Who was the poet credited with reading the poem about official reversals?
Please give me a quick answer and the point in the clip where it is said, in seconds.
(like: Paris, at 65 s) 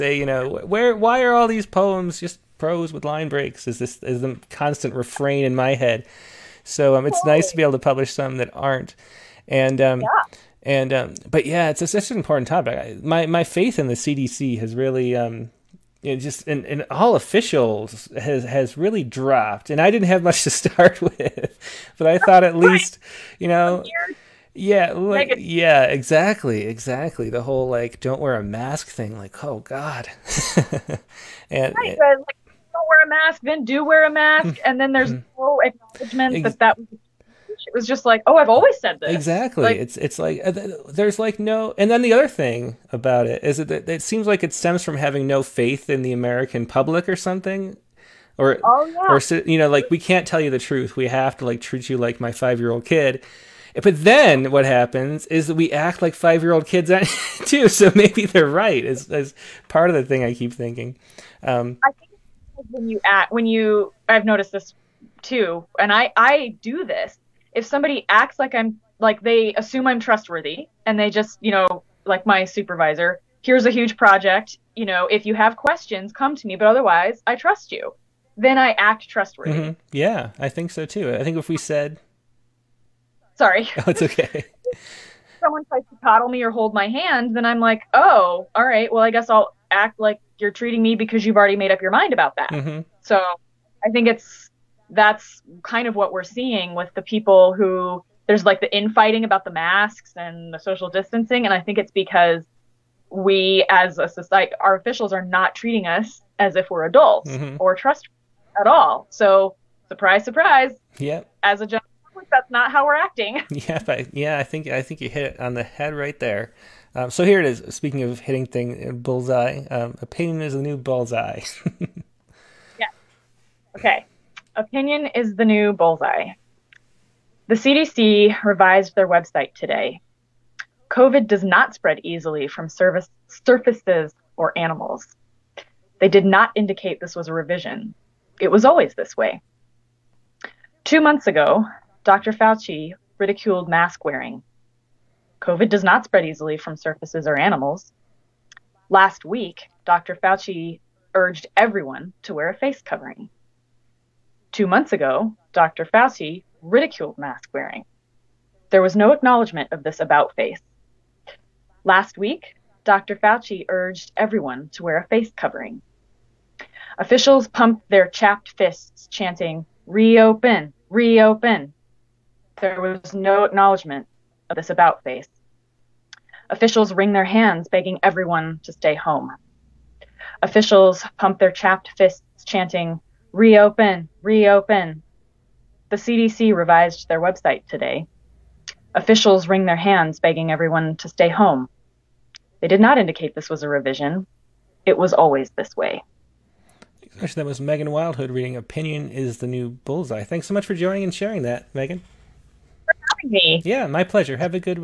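Megan Wildhood, at 197 s.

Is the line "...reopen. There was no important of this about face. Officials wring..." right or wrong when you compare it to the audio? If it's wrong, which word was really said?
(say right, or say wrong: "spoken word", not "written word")
wrong: "acknowledgement", not "important".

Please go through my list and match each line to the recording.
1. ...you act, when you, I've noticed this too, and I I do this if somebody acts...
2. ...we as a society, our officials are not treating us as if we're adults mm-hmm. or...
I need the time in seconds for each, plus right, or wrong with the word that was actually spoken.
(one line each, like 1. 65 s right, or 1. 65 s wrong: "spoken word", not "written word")
1. 62 s right
2. 103 s right.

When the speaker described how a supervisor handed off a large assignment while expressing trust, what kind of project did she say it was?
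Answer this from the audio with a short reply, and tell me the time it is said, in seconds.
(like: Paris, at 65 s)
huge project, at 73 s.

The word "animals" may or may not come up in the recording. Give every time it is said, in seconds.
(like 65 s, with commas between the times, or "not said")
134 s, 147 s.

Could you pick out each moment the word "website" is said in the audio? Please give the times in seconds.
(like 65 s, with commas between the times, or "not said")
129 s, 187 s.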